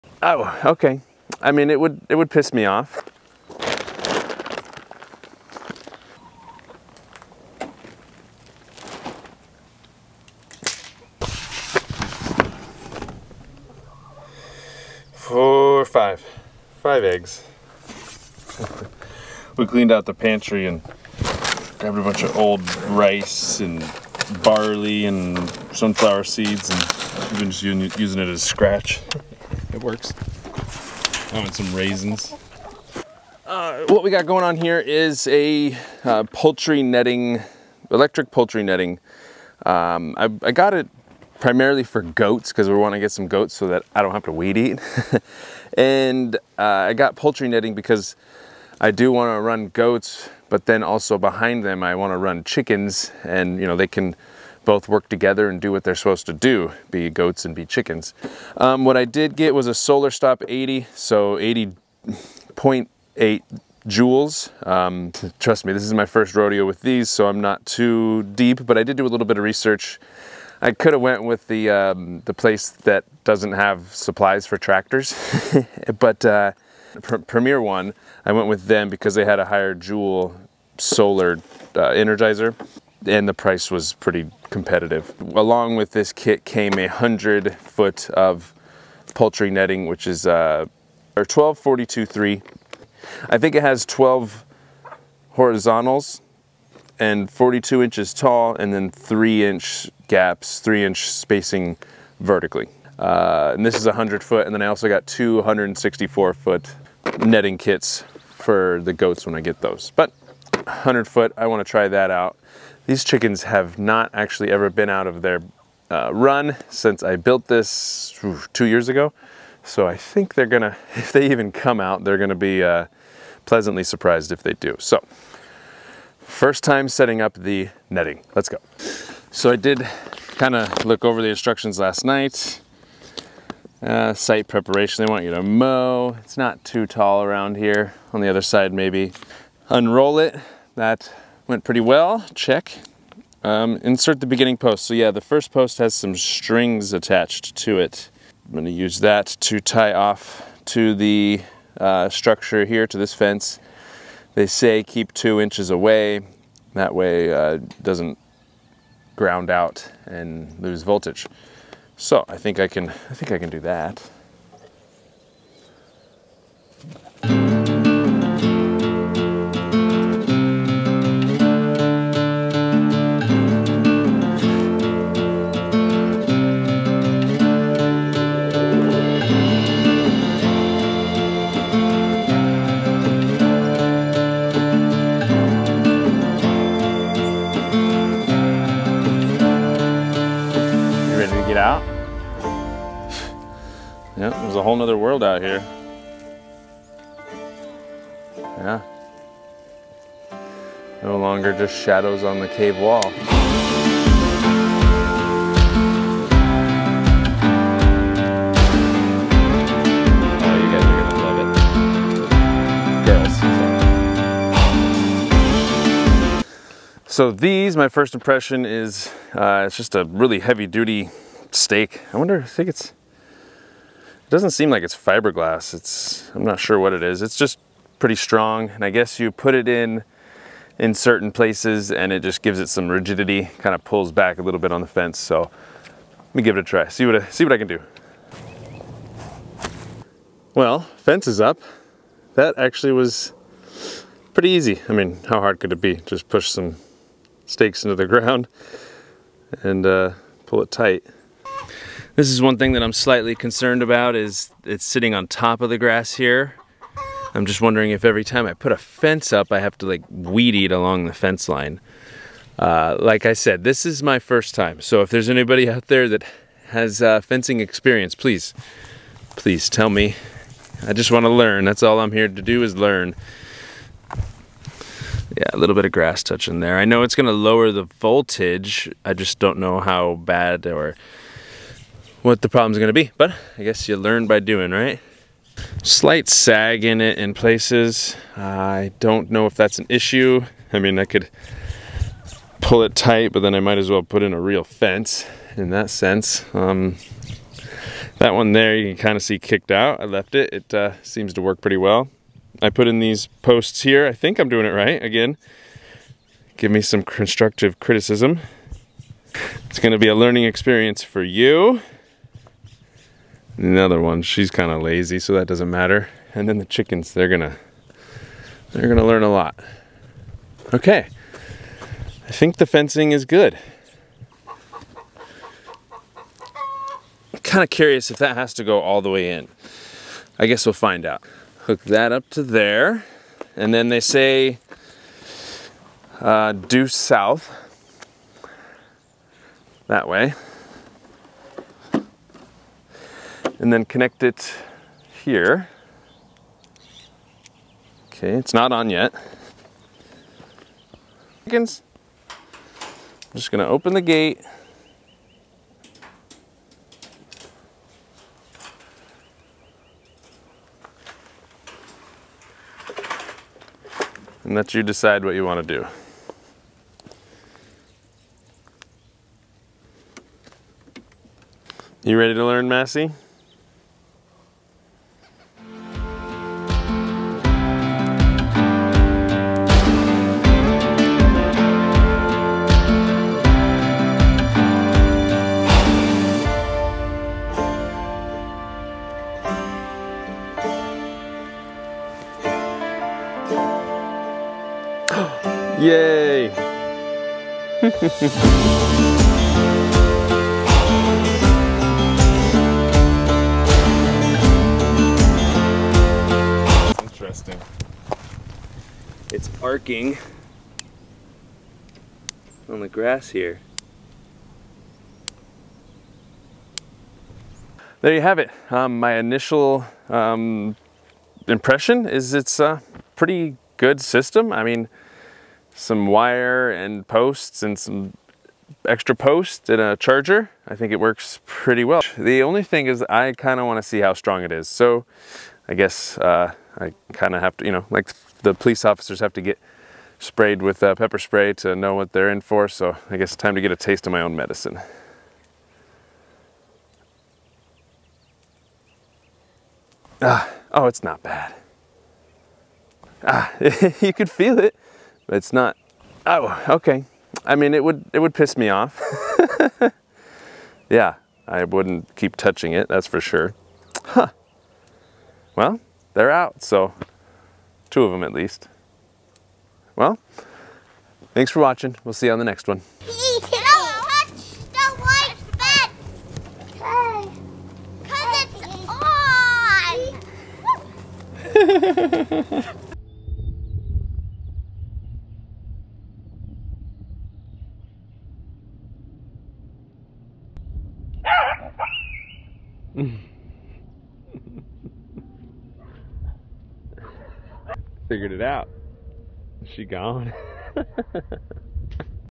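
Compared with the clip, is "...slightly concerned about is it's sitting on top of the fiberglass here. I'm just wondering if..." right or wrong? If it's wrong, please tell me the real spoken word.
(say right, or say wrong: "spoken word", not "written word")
wrong: "grass", not "fiberglass".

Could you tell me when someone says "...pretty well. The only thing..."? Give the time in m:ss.
7:11.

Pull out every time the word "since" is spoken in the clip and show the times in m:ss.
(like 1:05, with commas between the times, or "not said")
1:56.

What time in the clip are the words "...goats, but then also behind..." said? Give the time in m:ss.
0:49.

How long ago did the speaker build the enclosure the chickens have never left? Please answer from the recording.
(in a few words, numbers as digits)
2 years.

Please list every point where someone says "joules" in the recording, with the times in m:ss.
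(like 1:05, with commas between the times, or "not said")
1:03, 1:19.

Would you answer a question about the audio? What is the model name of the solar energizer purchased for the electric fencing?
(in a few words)
Solar Stop 80.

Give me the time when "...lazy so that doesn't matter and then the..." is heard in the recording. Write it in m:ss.
5:14.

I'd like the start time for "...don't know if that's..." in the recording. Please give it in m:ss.
4:48.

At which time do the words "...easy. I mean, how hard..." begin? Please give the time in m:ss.
4:04.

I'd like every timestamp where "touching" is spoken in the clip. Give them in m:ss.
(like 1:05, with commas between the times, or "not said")
4:36, 7:42.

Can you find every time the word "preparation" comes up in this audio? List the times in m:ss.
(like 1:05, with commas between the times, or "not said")
2:14.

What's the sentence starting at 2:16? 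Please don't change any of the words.
It's not too tall around here.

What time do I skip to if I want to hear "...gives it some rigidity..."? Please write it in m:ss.
3:52.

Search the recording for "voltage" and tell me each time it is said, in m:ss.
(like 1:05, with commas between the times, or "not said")
2:40, 4:37.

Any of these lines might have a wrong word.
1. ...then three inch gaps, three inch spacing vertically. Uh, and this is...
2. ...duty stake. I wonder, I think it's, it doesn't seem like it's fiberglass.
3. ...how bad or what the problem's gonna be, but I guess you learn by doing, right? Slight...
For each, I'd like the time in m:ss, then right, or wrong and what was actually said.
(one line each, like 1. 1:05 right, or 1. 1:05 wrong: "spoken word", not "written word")
1. 1:38 right
2. 3:40 right
3. 4:39 right.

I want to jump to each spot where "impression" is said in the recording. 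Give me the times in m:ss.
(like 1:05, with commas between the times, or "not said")
3:38, 7:01.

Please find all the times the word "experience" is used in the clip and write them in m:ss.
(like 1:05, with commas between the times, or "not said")
4:27, 5:10.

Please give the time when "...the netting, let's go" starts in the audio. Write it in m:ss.
2:07.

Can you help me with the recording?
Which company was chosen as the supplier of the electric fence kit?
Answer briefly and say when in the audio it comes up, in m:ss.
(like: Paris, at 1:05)
Premier One, at 1:17.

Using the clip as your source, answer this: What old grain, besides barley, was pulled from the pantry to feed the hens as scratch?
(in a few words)
rice.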